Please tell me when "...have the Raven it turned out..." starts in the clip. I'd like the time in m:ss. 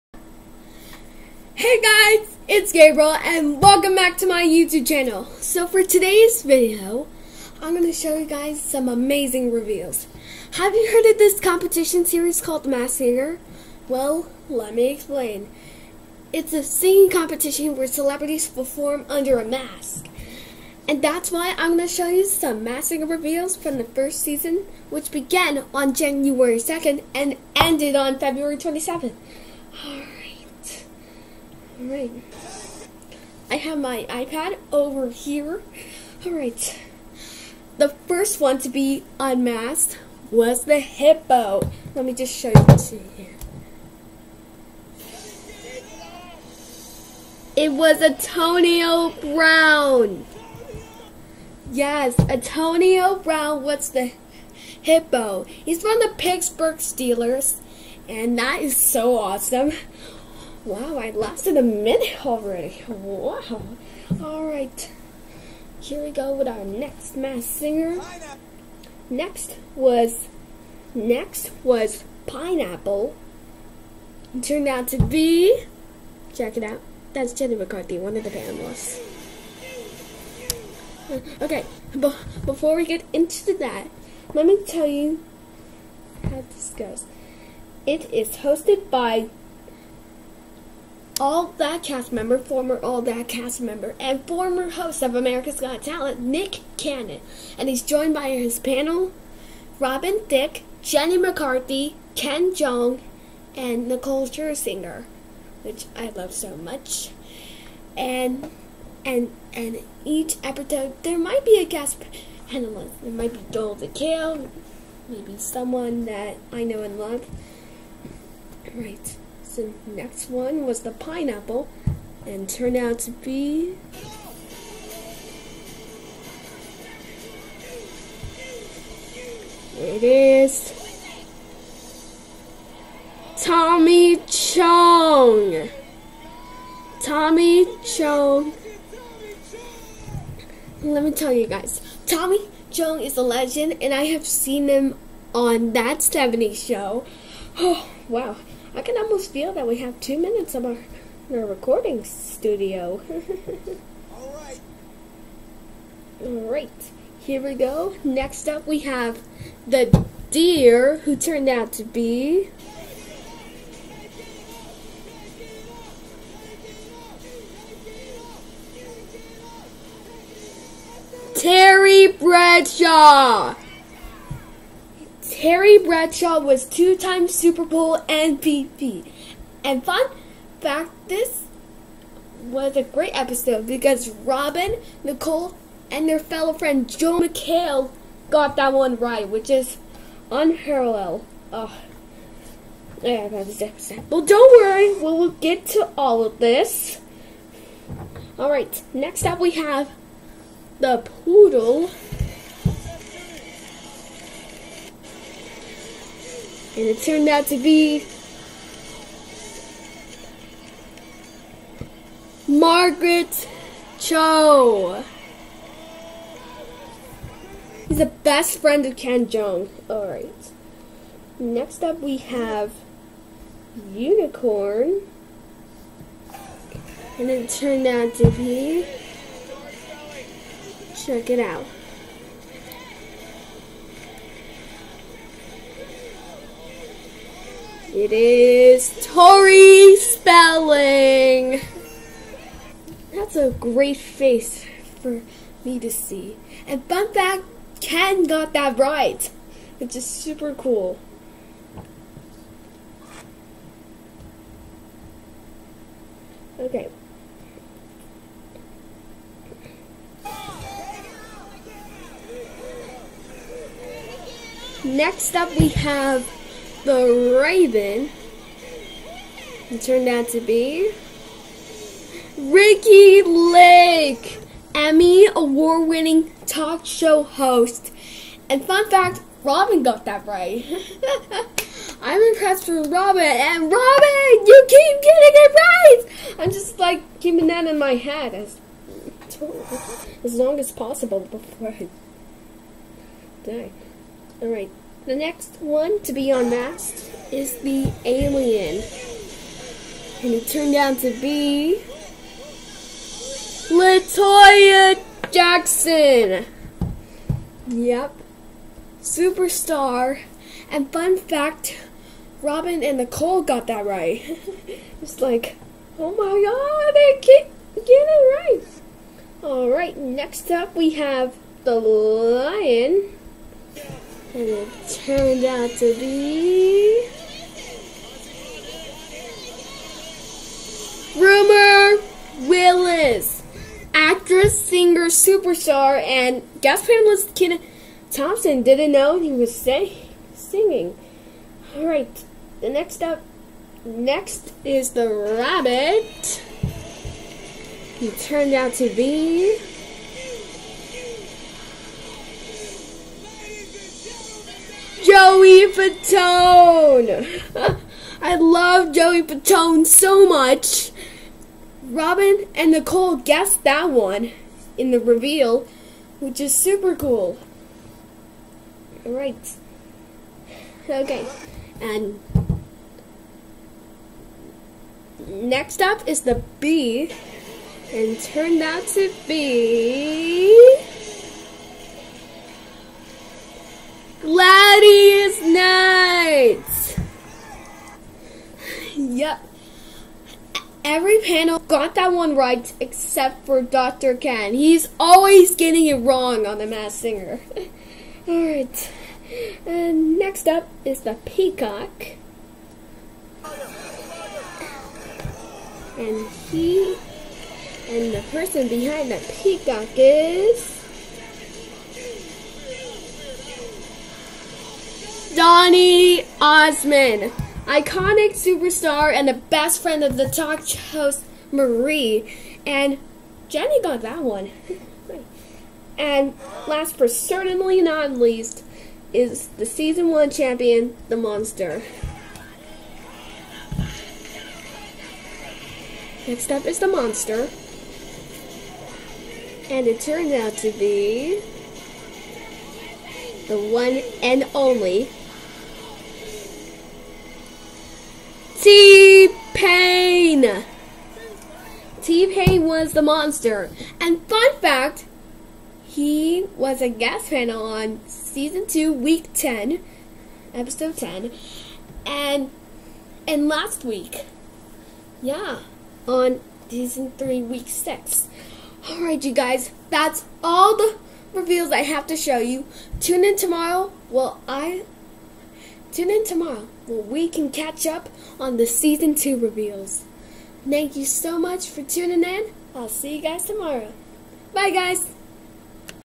4:25.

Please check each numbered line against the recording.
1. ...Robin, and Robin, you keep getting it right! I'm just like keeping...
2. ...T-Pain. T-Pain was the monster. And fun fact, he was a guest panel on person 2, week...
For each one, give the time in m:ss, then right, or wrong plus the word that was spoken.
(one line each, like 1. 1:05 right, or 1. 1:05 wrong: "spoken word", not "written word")
1. 4:42 right
2. 7:28 wrong: "season", not "person".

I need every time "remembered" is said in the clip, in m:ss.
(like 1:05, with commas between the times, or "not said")
not said.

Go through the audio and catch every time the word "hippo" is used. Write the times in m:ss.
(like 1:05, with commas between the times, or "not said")
0:40, 0:54.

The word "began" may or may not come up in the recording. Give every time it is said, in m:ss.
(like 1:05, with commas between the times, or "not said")
0:25.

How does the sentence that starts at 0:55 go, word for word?
He's from the Pittsburgh Steelers, and that is so awesome.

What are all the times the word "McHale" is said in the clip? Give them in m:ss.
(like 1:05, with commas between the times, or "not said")
1:53, 3:07.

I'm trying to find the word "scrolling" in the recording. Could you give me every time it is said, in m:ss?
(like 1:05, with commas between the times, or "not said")
not said.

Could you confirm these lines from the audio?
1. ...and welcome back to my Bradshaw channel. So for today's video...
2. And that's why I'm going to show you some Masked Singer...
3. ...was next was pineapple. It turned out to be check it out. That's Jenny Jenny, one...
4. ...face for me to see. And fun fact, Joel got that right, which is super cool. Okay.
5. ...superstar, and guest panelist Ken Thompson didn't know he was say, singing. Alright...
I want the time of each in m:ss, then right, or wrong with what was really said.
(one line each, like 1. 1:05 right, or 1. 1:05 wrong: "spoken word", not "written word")
1. 0:03 wrong: "YouTube", not "Bradshaw"
2. 0:20 right
3. 1:09 wrong: "McCarthy", not "Jenny"
4. 4:03 wrong: "Ken", not "Joel"
5. 5:35 right.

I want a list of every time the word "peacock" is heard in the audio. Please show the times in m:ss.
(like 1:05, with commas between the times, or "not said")
6:41, 6:49.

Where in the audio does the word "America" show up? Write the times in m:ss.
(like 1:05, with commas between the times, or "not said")
1:35.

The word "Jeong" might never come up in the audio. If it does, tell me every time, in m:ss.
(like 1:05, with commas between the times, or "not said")
1:42, 3:39.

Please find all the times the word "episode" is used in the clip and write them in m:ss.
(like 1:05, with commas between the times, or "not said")
1:50, 3:03, 3:13, 7:40.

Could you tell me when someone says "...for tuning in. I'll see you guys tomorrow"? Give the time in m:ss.
8:01.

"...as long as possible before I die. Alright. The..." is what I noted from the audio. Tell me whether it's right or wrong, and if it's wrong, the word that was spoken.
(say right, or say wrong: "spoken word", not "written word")
right.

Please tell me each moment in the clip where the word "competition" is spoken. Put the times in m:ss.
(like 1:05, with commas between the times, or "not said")
0:11, 0:17.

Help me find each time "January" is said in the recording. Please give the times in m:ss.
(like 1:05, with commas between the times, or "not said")
0:25.